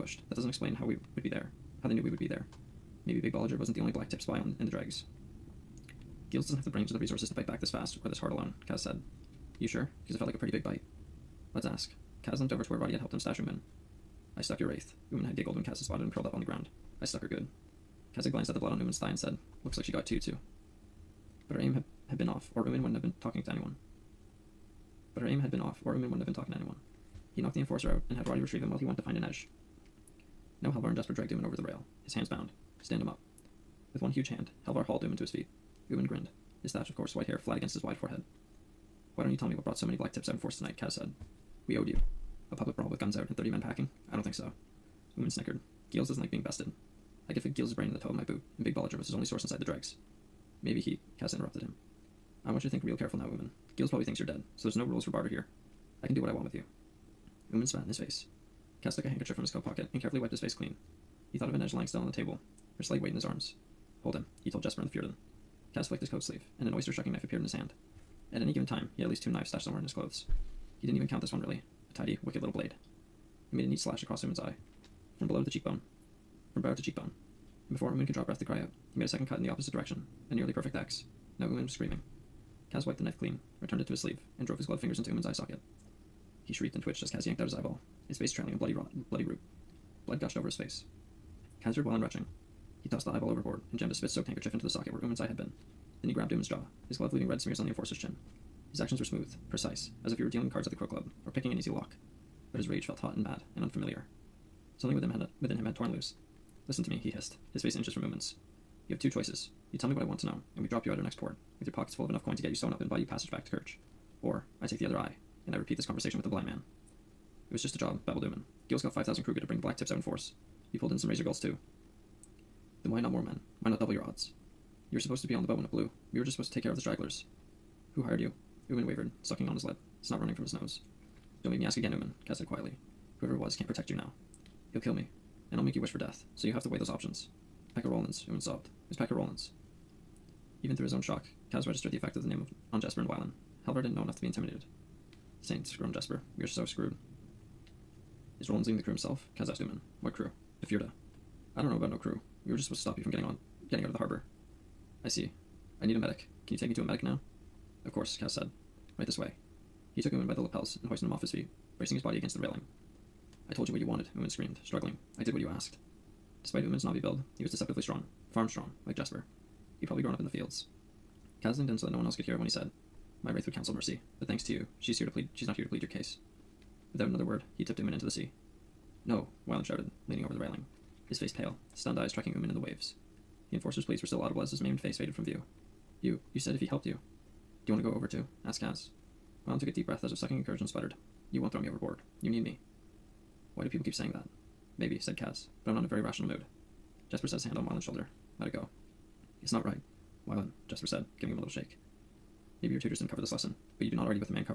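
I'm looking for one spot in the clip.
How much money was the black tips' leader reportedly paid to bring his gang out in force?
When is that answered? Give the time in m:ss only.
1:58.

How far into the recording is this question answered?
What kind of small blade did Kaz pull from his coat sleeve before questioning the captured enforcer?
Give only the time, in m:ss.
1:06.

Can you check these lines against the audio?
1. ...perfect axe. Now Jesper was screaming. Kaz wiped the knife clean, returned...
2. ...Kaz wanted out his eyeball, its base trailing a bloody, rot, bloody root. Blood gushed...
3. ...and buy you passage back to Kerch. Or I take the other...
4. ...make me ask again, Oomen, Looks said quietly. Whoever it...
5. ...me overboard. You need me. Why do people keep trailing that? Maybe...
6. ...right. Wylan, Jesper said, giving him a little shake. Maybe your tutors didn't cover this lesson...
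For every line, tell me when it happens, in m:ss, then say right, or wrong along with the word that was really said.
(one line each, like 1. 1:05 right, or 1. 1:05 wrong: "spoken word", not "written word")
1. 1:20 wrong: "Oomen", not "Jesper"
2. 1:27 wrong: "yanked", not "wanted"
3. 1:52 right
4. 2:11 wrong: "Kaz", not "Looks"
5. 3:11 wrong: "saying", not "trailing"
6. 3:19 right.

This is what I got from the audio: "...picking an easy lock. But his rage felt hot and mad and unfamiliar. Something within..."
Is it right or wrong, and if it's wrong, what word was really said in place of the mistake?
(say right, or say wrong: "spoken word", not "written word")
right.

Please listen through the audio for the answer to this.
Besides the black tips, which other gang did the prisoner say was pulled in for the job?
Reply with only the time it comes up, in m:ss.
2:01.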